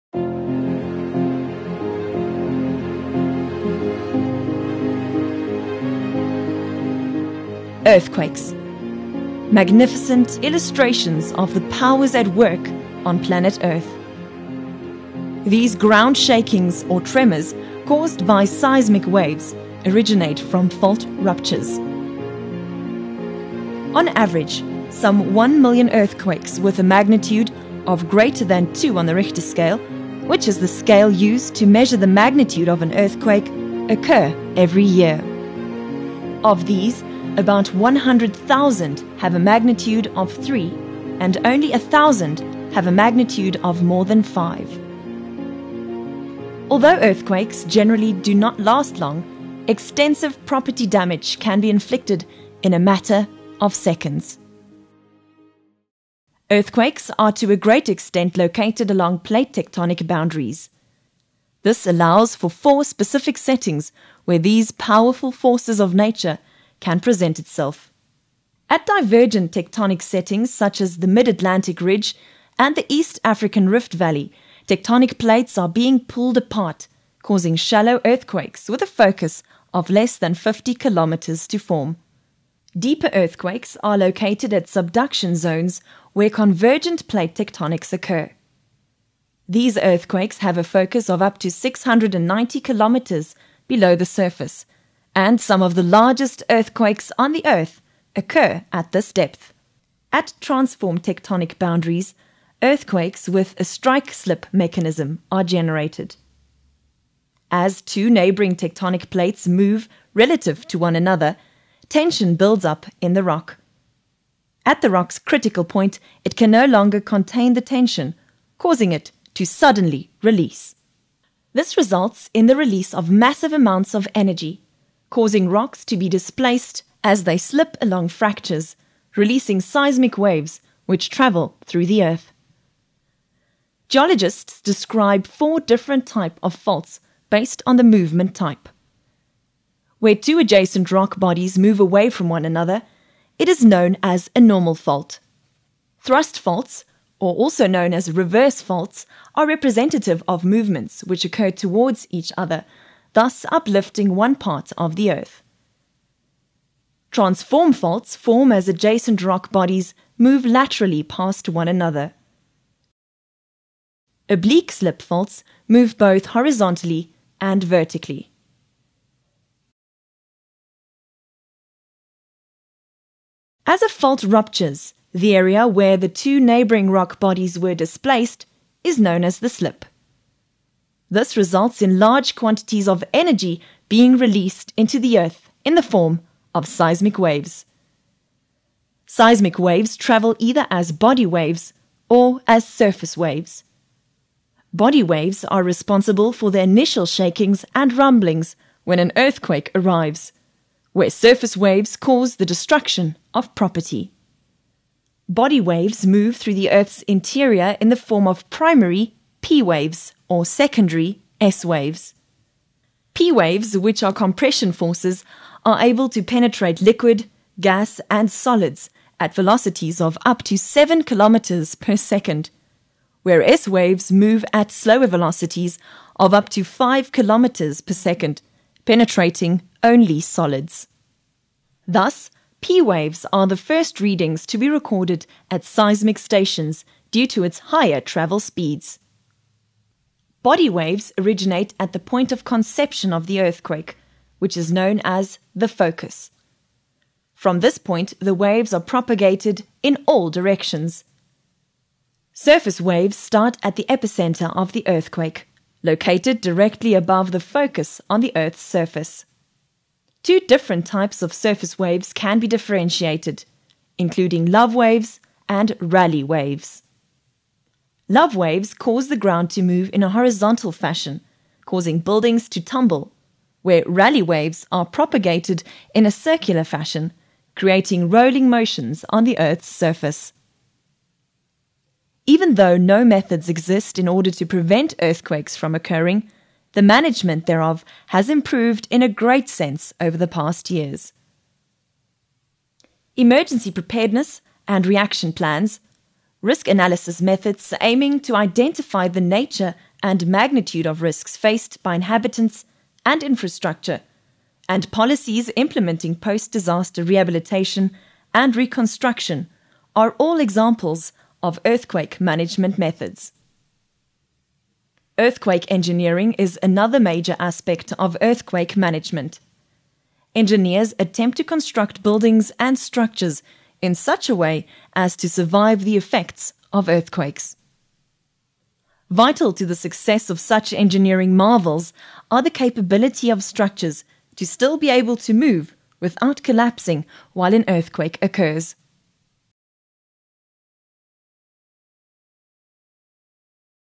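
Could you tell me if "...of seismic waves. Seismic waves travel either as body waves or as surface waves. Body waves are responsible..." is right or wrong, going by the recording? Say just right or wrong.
right.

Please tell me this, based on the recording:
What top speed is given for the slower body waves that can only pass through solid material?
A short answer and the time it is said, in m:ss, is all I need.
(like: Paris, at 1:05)
5 kilometers per second, at 3:46.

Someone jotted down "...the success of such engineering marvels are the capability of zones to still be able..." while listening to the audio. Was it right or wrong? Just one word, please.
wrong.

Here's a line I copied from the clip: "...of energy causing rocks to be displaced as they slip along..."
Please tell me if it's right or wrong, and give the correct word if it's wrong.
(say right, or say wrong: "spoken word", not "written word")
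right.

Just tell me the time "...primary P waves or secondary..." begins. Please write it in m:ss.
3:28.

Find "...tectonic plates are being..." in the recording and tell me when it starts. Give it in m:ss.
1:14.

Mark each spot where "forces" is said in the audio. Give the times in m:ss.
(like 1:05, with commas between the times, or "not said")
1:05, 3:34.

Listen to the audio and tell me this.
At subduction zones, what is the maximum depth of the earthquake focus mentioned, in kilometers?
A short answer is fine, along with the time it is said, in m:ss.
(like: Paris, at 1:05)
690 kilometers, at 1:31.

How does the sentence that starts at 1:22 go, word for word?
Deeper earthquakes are located at subduction zones where convergent plate tectonics occur.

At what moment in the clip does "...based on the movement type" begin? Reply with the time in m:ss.
2:17.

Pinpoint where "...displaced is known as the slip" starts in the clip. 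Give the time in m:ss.
2:57.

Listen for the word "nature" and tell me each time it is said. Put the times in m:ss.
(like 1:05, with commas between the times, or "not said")
1:05, 4:59.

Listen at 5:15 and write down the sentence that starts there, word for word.
Earthquake engineering is another major aspect of earthquake management.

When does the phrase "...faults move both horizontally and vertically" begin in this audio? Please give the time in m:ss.
2:45.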